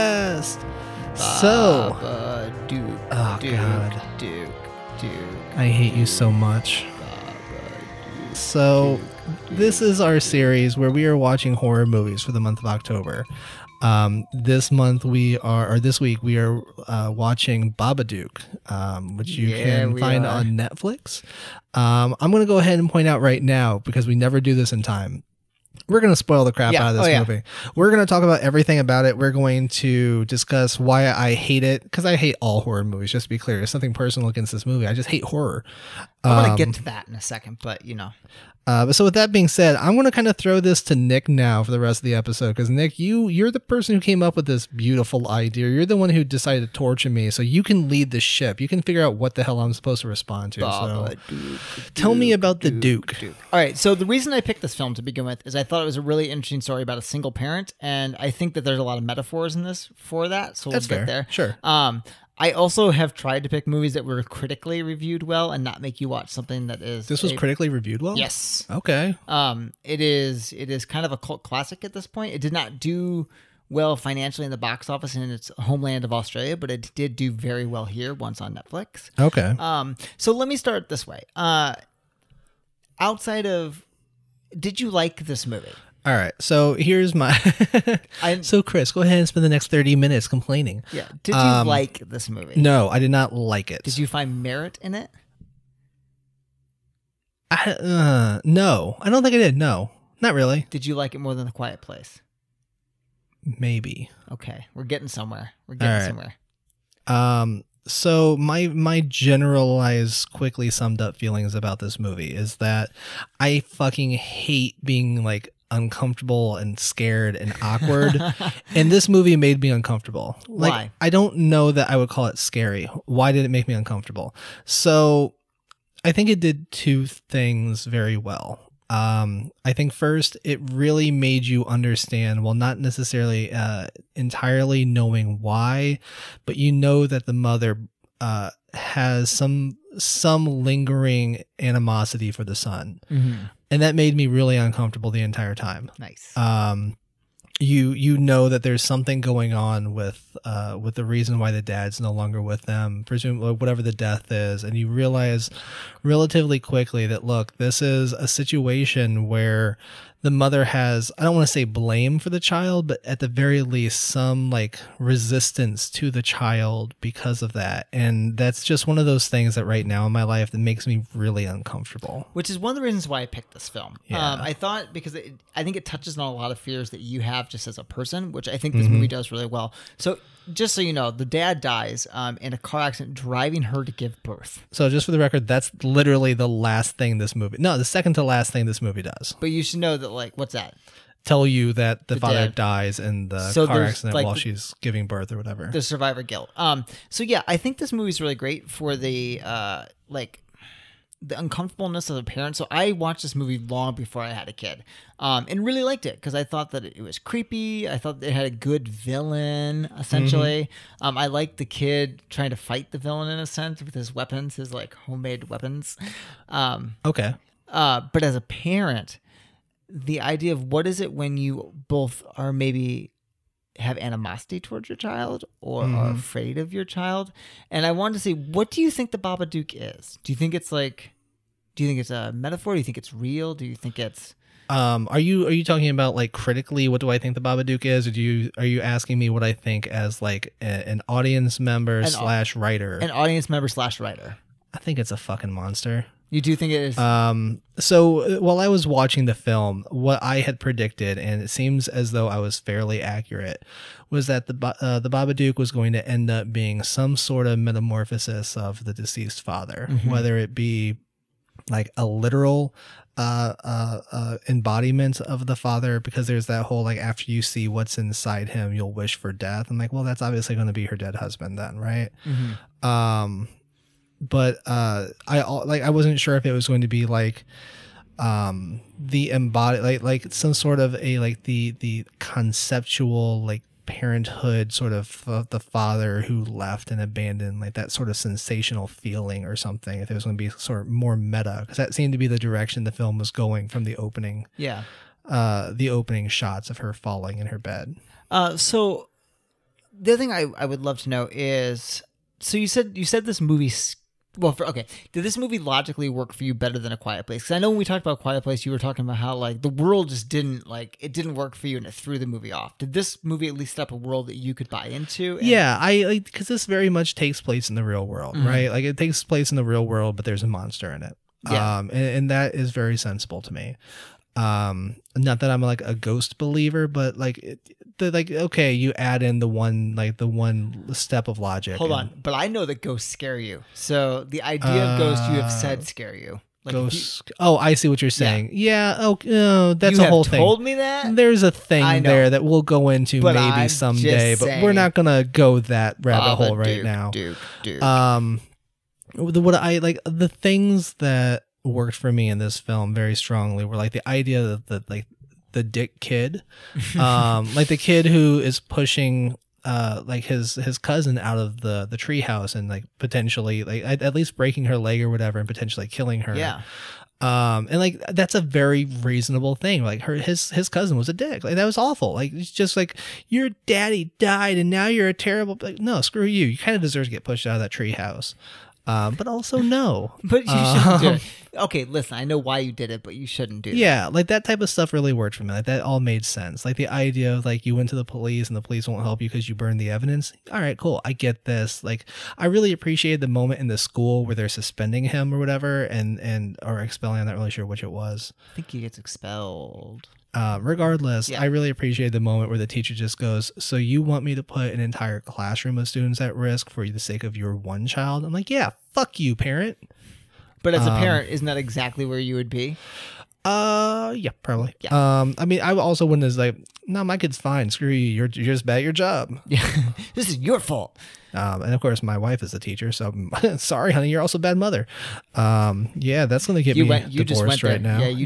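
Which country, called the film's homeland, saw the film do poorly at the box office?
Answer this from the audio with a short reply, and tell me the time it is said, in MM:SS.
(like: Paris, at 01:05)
Australia, at 01:16.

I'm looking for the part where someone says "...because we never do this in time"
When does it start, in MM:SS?
00:23.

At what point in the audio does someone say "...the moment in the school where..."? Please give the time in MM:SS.
06:33.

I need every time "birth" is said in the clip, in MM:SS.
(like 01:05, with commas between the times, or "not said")
03:04, 03:15.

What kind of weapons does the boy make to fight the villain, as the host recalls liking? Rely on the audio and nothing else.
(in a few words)
Homemade weapons.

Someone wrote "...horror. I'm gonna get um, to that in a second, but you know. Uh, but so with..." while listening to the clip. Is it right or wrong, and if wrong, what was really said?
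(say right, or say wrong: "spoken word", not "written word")
right.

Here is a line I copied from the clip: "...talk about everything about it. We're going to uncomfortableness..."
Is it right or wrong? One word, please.
wrong.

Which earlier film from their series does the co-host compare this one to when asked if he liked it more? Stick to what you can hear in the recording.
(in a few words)
A Quiet Place.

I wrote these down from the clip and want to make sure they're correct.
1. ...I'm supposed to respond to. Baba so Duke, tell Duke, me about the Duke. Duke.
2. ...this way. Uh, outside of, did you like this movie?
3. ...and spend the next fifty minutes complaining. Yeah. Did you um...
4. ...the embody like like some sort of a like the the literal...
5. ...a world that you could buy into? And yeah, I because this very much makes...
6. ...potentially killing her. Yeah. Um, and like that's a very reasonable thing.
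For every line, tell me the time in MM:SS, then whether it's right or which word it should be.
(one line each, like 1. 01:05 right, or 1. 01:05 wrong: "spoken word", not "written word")
1. 00:49 right
2. 01:20 right
3. 01:29 wrong: "thirty", not "fifty"
4. 04:38 wrong: "conceptual", not "literal"
5. 05:13 wrong: "takes", not "makes"
6. 06:05 right.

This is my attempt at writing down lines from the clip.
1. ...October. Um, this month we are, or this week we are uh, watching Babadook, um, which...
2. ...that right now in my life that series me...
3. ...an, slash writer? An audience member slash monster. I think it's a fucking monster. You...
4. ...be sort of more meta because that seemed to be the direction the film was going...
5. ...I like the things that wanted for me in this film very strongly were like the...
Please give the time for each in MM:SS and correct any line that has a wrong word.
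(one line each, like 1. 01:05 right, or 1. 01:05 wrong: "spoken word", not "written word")
1. 00:12 right
2. 02:49 wrong: "makes", not "series"
3. 04:01 wrong: "writer", not "monster"
4. 04:50 right
5. 05:49 wrong: "worked", not "wanted".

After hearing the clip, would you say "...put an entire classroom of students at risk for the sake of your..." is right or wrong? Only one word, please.
right.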